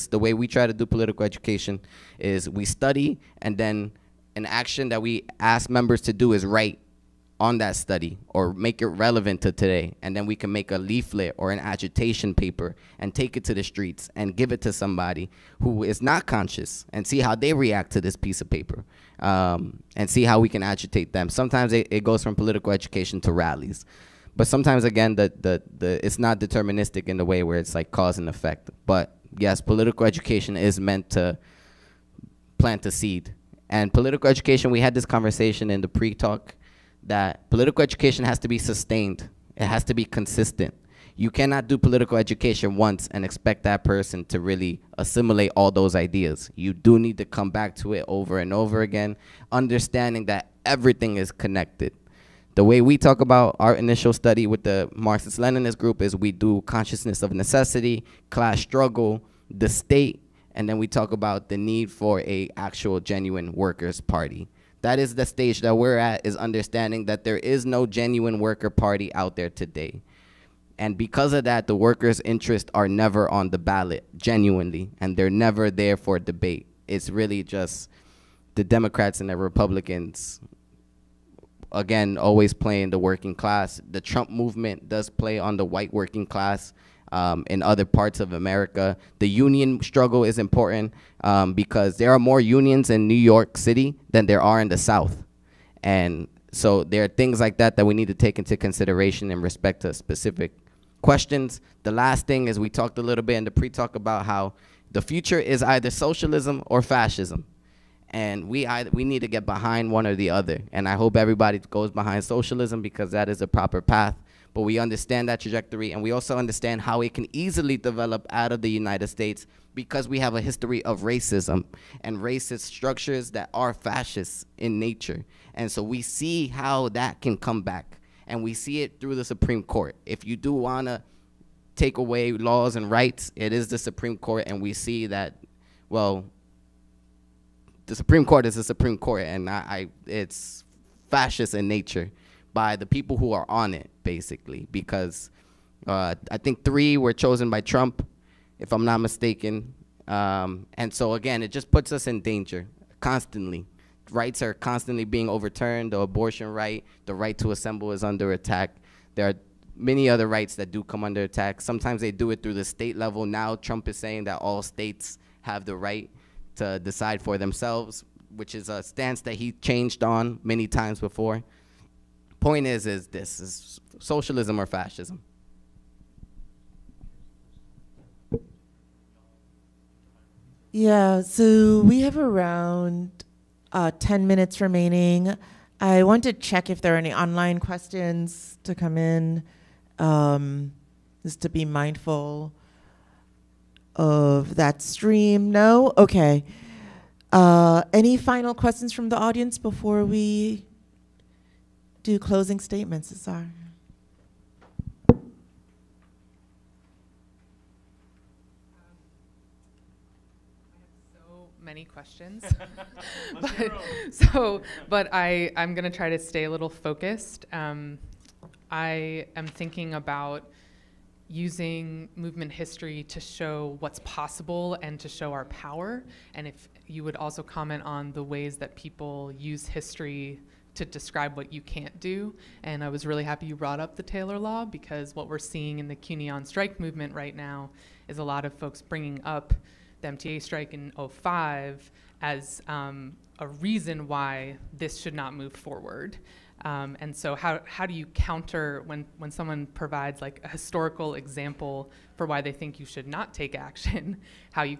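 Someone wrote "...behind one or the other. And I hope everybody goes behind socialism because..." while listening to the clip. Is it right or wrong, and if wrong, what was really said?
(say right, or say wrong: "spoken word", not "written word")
right.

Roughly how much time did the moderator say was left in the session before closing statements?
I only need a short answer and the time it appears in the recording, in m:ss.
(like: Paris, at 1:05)
10 minutes, at 3:03.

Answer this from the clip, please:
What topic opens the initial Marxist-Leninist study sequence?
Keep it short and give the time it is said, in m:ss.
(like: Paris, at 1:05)
Consciousness of necessity, at 0:56.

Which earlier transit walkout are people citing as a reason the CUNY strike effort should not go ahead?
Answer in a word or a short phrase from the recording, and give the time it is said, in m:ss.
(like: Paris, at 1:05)
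MTA strike in 2005, at 4:00.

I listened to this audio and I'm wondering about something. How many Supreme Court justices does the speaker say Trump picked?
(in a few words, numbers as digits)
3.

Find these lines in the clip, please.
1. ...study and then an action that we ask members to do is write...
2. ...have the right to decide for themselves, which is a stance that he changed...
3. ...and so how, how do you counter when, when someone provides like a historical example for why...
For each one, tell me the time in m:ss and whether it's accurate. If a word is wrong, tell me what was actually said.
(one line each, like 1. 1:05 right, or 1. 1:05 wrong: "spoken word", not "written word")
1. 0:02 right
2. 2:45 right
3. 4:07 right.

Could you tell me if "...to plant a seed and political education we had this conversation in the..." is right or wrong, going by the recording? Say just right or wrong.
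right.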